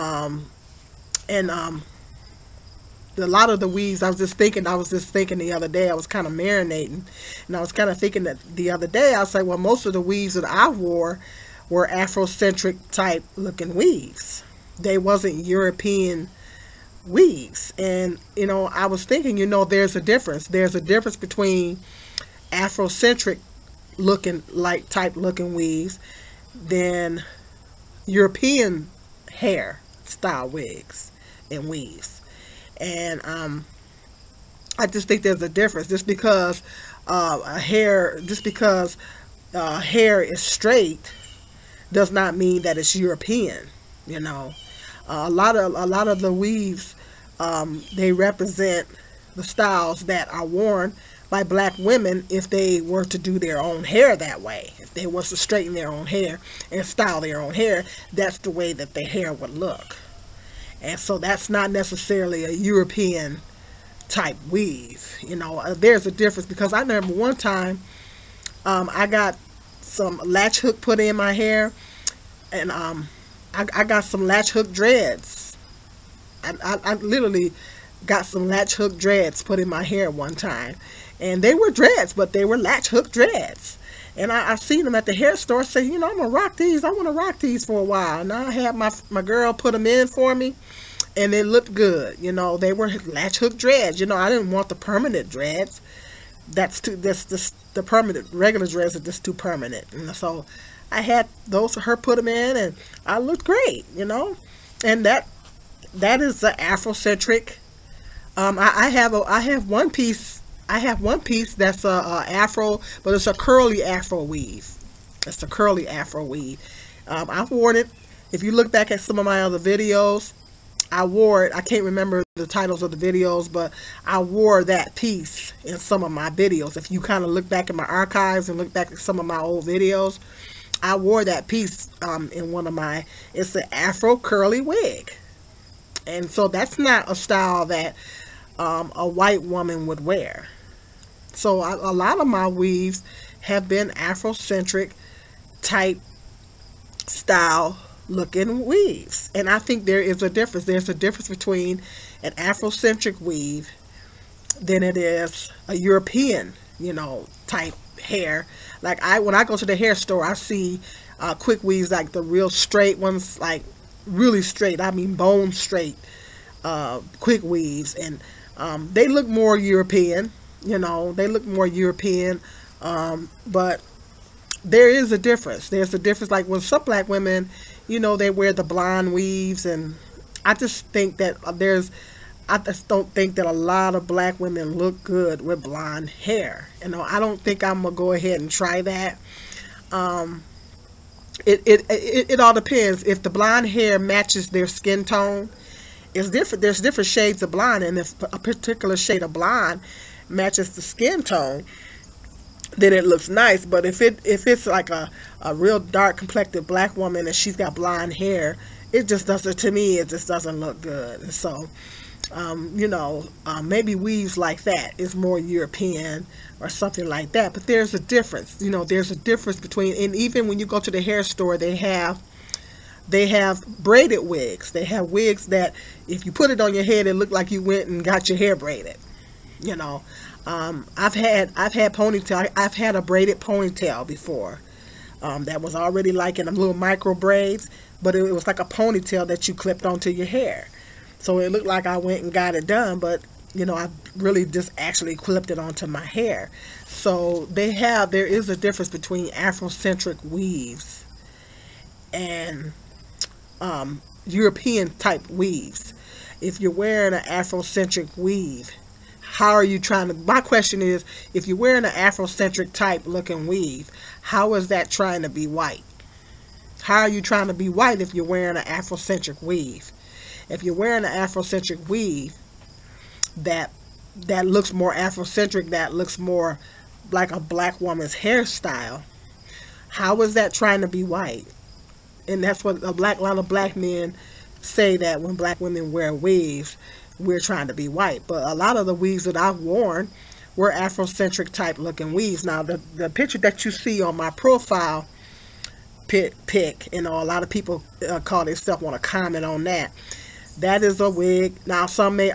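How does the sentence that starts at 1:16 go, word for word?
I, I, I literally got some latch hook dreads put in my hair one time.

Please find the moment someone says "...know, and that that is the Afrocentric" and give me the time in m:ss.
1:44.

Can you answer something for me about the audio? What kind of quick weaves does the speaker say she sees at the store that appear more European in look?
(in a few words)
bone straight.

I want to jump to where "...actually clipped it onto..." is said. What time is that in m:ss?
4:04.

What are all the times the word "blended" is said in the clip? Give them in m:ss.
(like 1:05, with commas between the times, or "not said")
not said.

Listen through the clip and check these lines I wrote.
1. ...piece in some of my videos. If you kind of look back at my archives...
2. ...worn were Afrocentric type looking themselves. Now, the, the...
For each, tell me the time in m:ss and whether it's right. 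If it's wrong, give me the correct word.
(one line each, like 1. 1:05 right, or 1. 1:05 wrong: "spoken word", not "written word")
1. 2:04 right
2. 4:49 wrong: "weaves", not "themselves".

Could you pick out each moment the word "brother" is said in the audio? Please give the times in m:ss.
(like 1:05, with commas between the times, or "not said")
not said.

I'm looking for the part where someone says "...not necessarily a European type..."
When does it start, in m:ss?
1:01.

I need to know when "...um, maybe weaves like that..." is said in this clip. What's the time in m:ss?
3:33.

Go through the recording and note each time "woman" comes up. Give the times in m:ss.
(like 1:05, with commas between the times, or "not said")
2:19, 3:26, 4:37.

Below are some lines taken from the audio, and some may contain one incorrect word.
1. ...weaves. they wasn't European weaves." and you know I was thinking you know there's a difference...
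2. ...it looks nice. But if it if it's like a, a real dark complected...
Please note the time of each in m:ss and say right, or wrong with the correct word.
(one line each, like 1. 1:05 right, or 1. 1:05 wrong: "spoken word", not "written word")
1. 0:13 right
2. 3:22 right.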